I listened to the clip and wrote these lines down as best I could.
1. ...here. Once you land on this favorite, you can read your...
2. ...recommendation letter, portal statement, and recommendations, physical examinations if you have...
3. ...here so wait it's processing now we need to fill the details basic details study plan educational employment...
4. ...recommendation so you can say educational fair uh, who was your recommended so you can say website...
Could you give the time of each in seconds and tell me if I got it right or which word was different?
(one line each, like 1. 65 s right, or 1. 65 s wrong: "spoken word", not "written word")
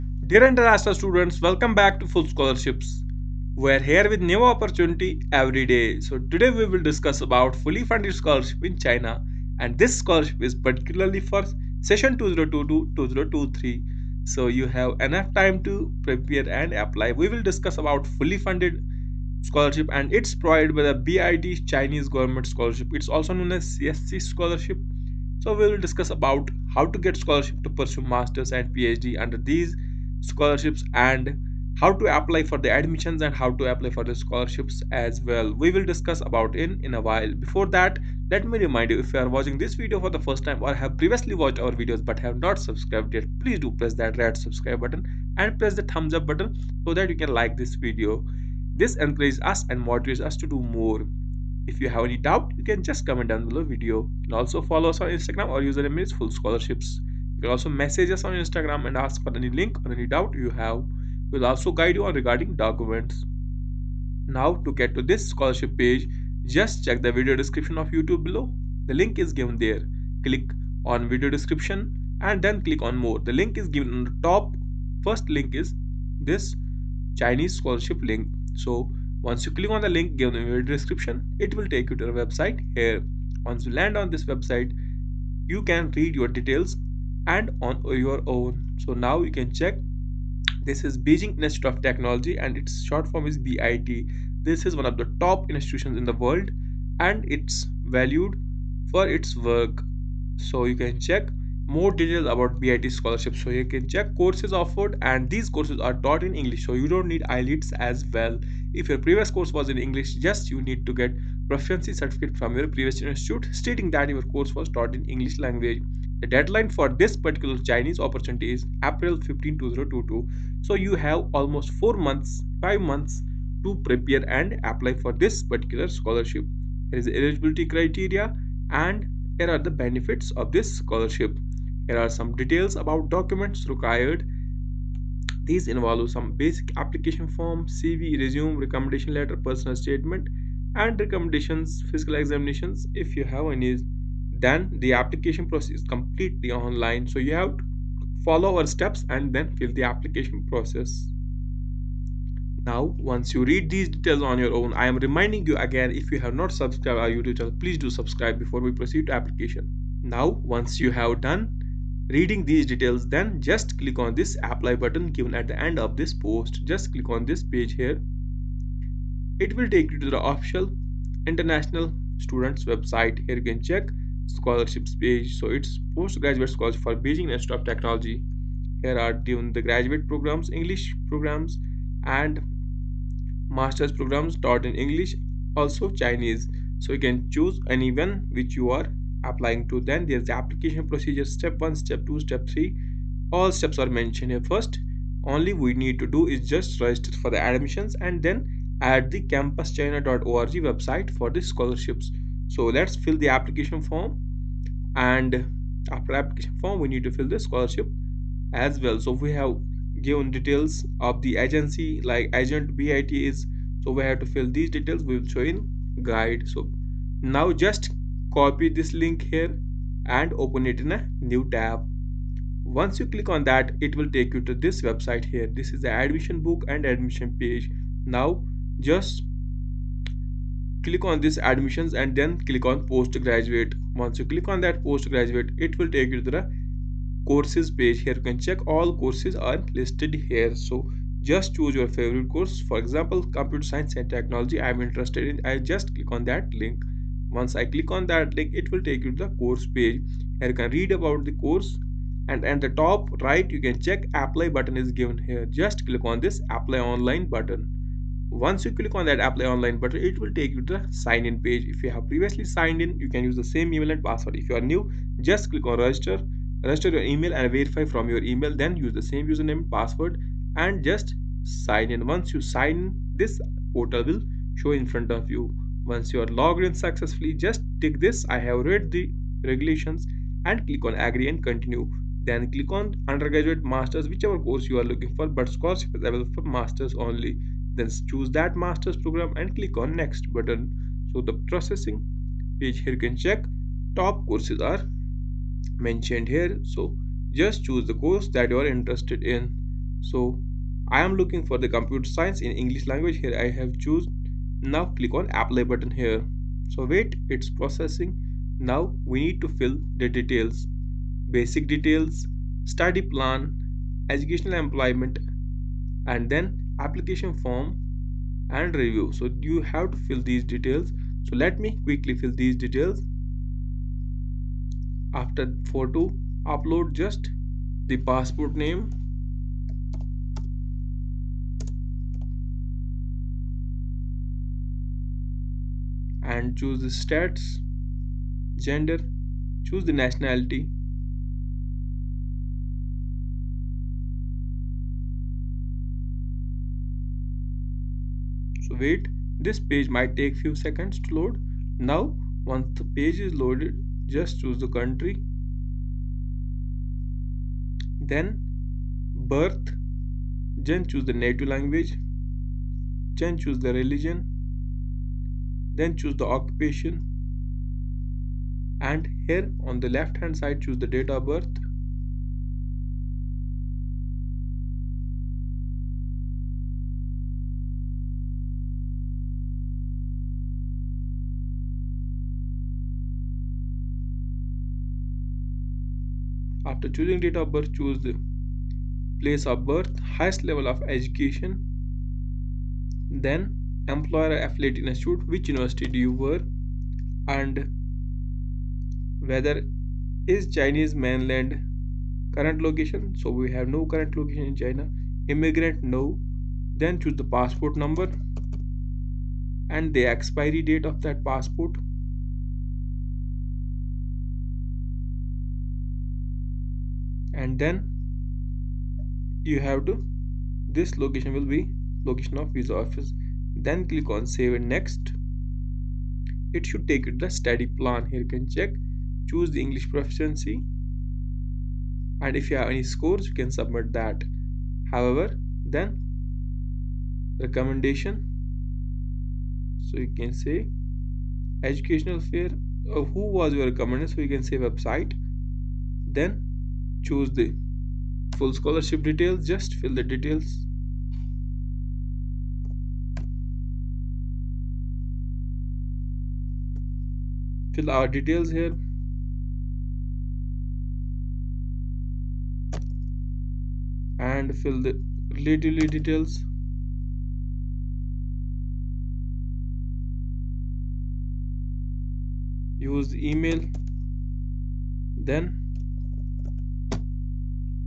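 1. 82 s wrong: "website", not "favorite"
2. 138 s wrong: "personal", not "portal"
3. 305 s right
4. 437 s right.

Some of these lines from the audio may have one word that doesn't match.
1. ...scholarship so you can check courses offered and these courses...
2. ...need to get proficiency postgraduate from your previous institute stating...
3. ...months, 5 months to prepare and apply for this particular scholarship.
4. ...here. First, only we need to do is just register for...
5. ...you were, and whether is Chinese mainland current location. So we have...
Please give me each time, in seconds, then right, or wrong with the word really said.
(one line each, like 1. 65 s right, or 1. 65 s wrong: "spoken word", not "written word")
1. 102 s right
2. 110 s wrong: "certificate", not "postgraduate"
3. 121 s right
4. 194 s right
5. 395 s right.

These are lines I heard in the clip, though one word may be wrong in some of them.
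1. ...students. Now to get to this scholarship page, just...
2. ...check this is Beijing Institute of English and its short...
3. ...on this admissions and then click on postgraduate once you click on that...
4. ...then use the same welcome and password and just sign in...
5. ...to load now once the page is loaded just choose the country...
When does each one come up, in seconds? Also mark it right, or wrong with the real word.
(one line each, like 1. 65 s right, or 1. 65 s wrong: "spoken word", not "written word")
1. 62 s wrong: "documents", not "students"
2. 89 s wrong: "Technology", not "English"
3. 231 s right
4. 268 s wrong: "username", not "welcome"
5. 351 s right.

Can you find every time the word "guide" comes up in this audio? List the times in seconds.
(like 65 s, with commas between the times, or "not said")
61 s, 216 s.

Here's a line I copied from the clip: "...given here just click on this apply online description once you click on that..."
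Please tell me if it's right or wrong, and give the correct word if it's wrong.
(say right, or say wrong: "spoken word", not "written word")
wrong: "button", not "description".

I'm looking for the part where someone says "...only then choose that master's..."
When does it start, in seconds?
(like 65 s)
286 s.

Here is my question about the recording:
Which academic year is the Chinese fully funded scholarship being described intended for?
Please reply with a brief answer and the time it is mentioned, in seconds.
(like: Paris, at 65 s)
2022-2023, at 12 s.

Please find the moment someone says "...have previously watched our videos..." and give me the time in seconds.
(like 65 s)
40 s.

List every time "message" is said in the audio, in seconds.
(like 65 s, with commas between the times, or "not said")
57 s.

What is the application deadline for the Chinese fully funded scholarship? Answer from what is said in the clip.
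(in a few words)
April 15, 2022.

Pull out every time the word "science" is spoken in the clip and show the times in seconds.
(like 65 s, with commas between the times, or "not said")
243 s, 302 s.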